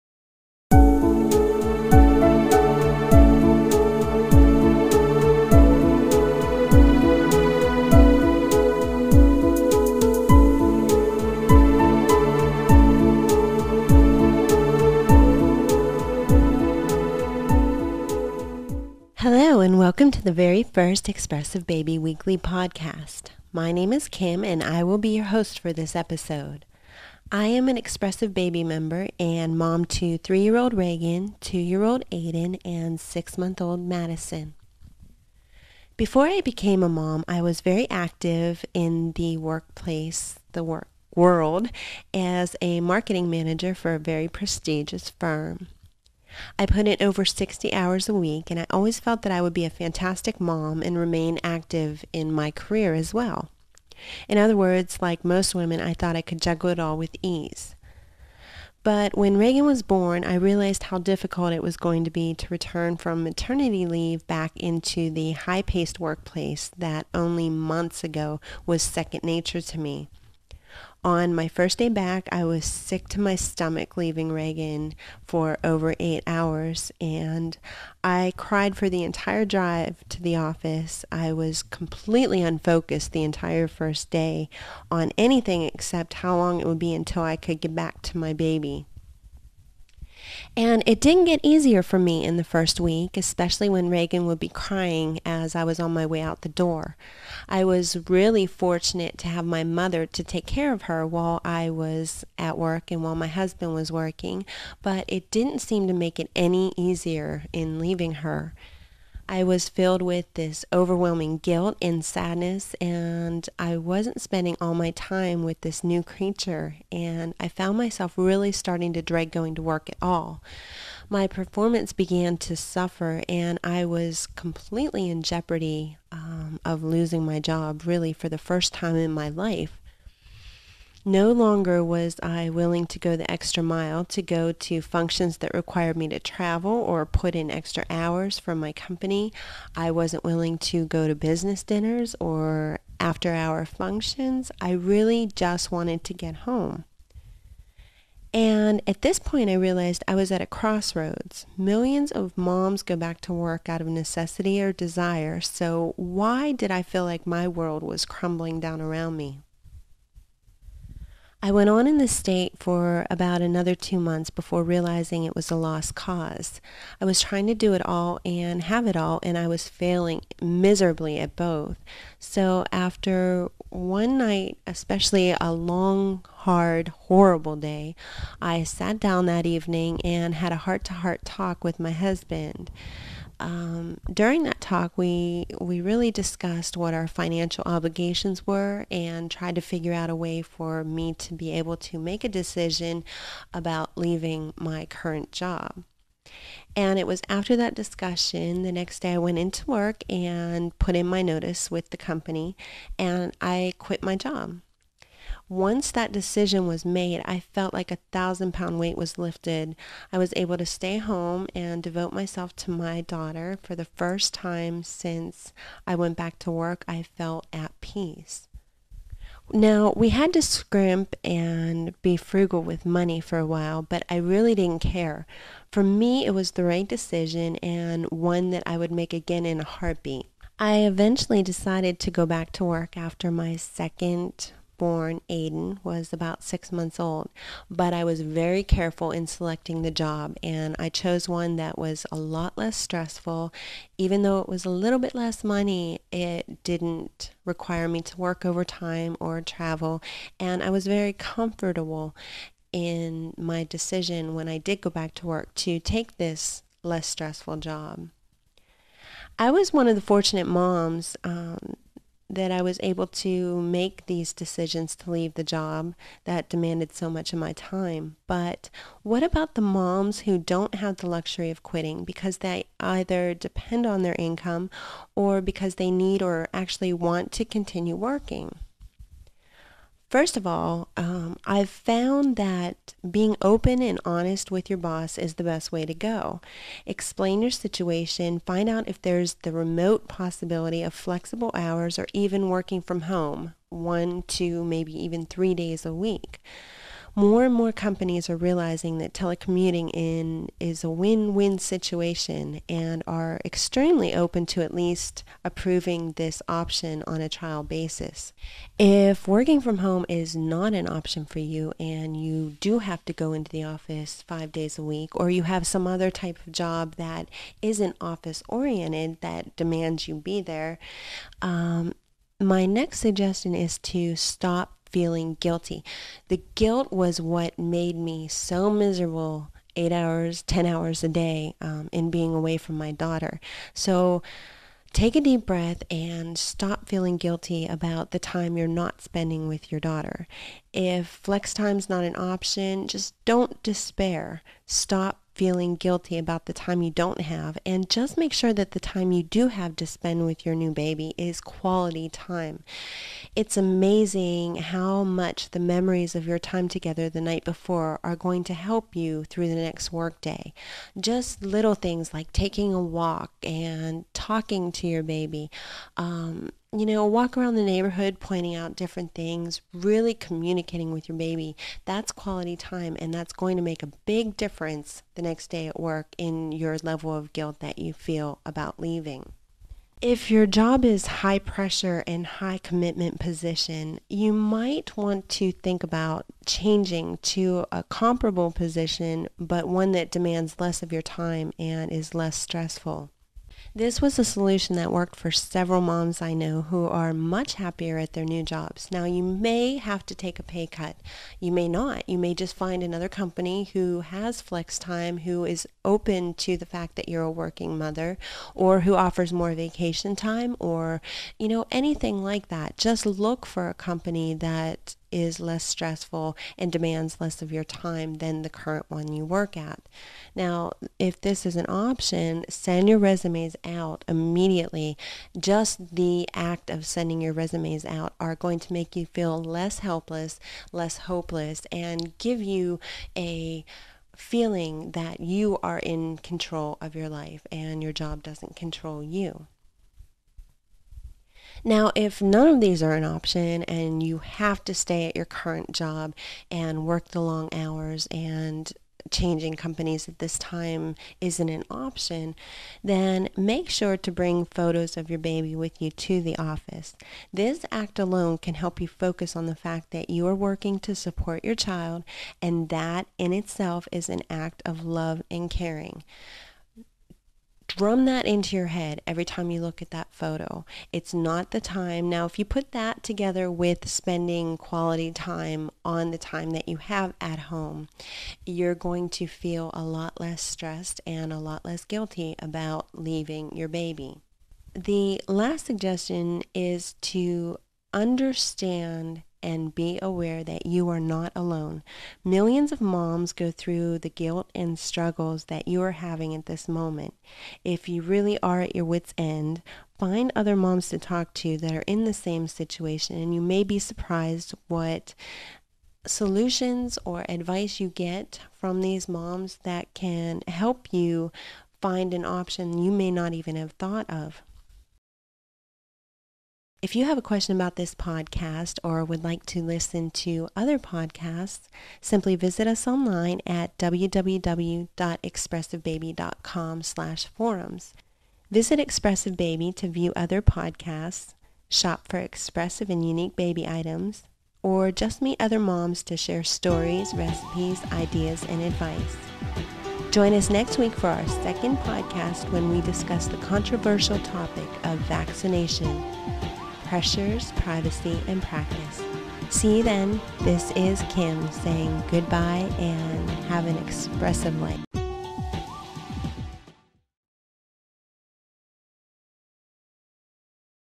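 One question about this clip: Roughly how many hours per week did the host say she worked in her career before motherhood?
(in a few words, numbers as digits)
Over 60.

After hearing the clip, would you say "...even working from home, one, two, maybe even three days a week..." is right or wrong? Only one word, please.
right.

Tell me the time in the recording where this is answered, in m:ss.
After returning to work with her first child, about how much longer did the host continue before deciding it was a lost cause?
2:43.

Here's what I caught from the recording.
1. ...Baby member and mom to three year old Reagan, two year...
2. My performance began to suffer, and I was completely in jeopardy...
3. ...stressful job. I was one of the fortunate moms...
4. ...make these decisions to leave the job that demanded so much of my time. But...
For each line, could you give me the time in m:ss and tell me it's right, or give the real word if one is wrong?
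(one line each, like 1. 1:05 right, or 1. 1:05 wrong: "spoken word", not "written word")
1. 0:28 right
2. 2:01 right
3. 4:17 right
4. 4:23 right.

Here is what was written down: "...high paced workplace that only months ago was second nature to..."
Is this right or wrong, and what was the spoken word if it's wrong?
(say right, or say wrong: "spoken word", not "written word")
right.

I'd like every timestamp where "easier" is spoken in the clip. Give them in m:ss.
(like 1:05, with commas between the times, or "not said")
1:31, 1:46.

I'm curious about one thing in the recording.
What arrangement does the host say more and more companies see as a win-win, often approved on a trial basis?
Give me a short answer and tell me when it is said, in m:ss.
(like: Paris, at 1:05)
Telecommuting, at 4:59.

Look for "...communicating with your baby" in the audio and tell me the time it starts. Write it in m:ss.
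6:10.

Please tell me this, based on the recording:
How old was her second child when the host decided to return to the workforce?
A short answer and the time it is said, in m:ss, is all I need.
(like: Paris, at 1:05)
Six months, at 3:56.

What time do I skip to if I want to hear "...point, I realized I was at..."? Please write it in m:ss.
2:29.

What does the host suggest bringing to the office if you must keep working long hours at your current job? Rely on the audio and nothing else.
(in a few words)
Photos of your baby.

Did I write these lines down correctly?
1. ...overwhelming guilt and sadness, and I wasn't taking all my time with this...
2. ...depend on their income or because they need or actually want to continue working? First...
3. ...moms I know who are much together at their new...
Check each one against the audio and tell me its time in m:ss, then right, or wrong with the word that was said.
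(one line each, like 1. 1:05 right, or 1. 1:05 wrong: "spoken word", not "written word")
1. 1:50 wrong: "spending", not "taking"
2. 4:33 right
3. 6:35 wrong: "happier", not "together".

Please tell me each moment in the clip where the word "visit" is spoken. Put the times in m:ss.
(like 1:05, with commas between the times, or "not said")
8:42, 8:48.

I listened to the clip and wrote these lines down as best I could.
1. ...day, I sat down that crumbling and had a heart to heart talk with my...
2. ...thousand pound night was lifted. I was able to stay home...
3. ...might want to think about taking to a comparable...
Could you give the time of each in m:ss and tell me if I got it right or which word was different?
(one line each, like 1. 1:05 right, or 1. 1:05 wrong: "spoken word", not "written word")
1. 2:57 wrong: "evening", not "crumbling"
2. 3:28 wrong: "weight", not "night"
3. 6:24 wrong: "changing", not "taking".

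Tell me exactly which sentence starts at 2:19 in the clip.
I wasn't willing to go to business dinners or after hour functions.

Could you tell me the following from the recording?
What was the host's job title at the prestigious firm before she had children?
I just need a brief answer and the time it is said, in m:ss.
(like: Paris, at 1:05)
Marketing manager, at 0:42.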